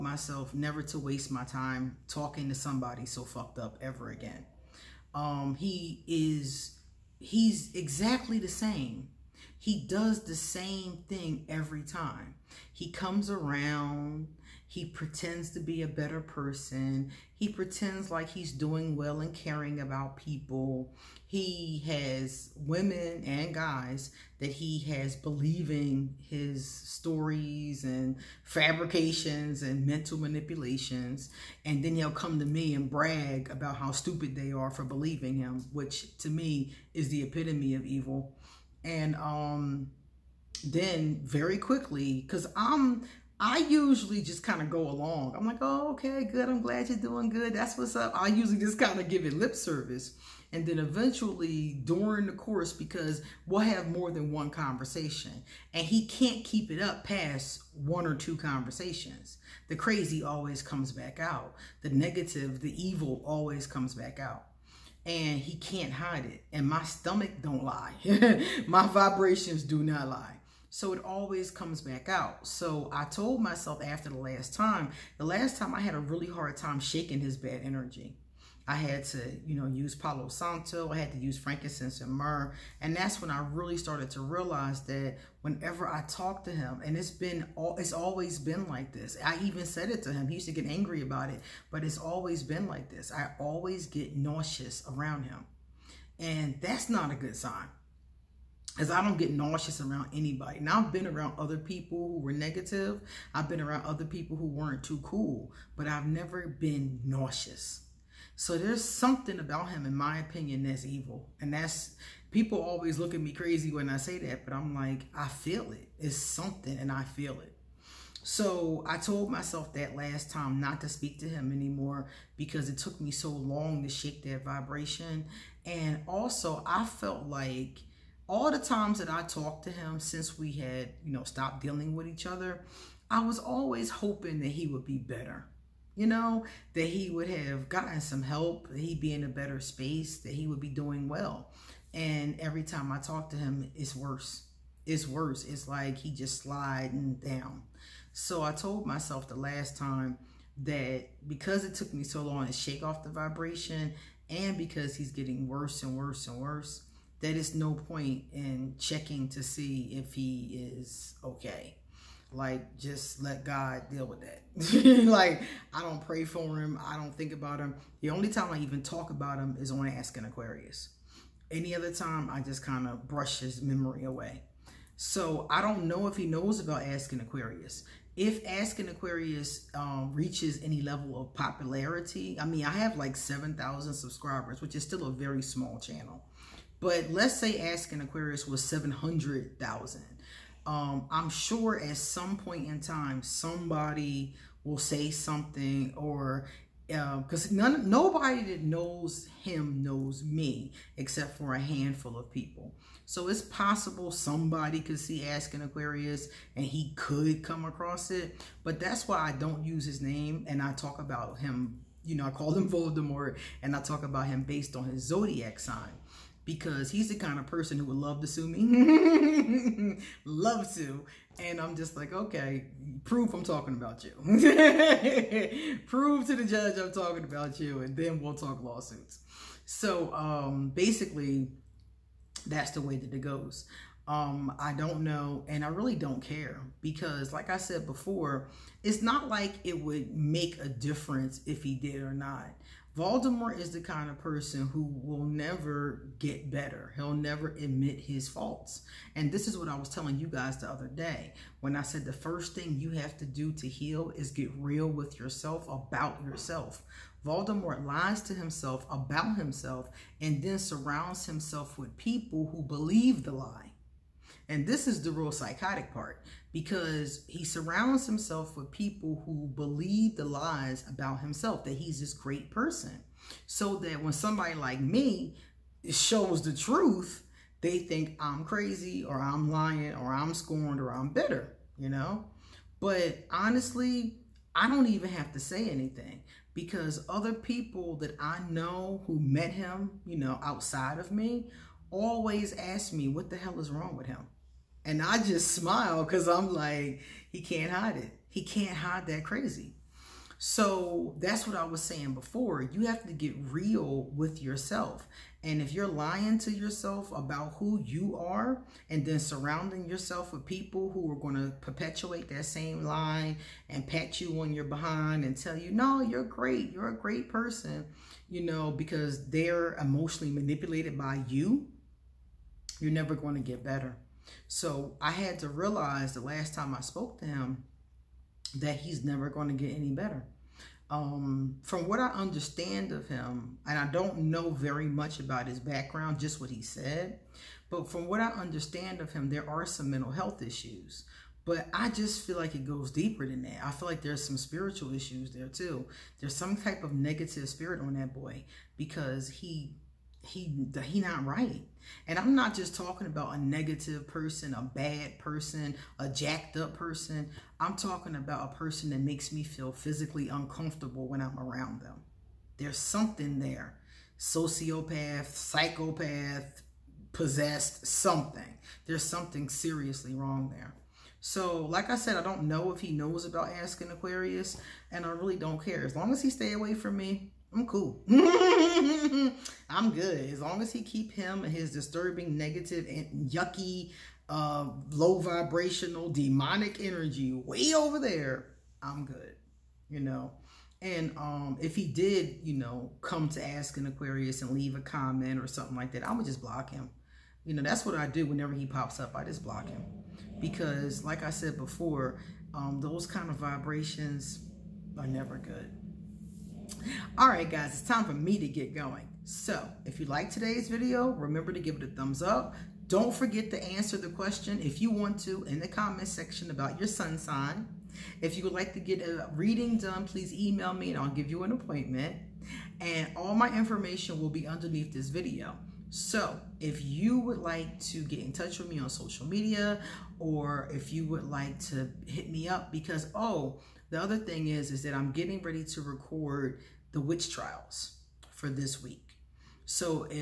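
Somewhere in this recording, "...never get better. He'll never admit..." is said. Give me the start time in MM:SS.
04:05.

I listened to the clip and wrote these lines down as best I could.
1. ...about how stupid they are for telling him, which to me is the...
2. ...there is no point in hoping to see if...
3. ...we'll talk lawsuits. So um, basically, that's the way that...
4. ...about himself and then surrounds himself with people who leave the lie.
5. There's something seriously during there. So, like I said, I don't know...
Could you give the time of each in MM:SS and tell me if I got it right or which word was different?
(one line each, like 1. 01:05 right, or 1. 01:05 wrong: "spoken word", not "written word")
1. 00:33 wrong: "believing", not "telling"
2. 02:37 wrong: "checking", not "hoping"
3. 03:48 right
4. 04:18 wrong: "believe", not "leave"
5. 06:08 wrong: "wrong", not "during".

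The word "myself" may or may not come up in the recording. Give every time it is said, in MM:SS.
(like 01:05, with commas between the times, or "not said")
00:00, 01:13, 01:59, 02:28.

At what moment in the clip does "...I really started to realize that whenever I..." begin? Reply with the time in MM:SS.
01:23.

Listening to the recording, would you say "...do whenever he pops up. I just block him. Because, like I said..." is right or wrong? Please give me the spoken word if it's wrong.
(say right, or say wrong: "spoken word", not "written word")
right.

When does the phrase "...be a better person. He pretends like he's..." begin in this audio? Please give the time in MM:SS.
00:15.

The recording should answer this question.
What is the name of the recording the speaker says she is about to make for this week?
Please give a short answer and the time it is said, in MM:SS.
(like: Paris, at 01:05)
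the witch trials, at 07:16.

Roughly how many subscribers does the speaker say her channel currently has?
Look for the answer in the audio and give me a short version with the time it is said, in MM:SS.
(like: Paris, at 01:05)
7,000, at 03:03.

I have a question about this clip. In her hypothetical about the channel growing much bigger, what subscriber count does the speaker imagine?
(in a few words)
700,000.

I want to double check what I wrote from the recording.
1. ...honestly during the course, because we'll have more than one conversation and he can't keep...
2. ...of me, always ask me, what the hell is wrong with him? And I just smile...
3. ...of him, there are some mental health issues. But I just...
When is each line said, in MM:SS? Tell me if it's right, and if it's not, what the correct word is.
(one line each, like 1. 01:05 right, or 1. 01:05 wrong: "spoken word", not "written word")
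1. 00:50 wrong: "eventually", not "honestly"
2. 04:50 right
3. 05:39 right.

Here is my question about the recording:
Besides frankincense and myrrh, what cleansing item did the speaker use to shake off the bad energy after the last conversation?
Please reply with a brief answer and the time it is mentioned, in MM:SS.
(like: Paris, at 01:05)
Palo Santo, at 01:19.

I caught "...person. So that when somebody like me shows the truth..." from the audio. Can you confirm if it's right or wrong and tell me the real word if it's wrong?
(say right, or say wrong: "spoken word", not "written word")
right.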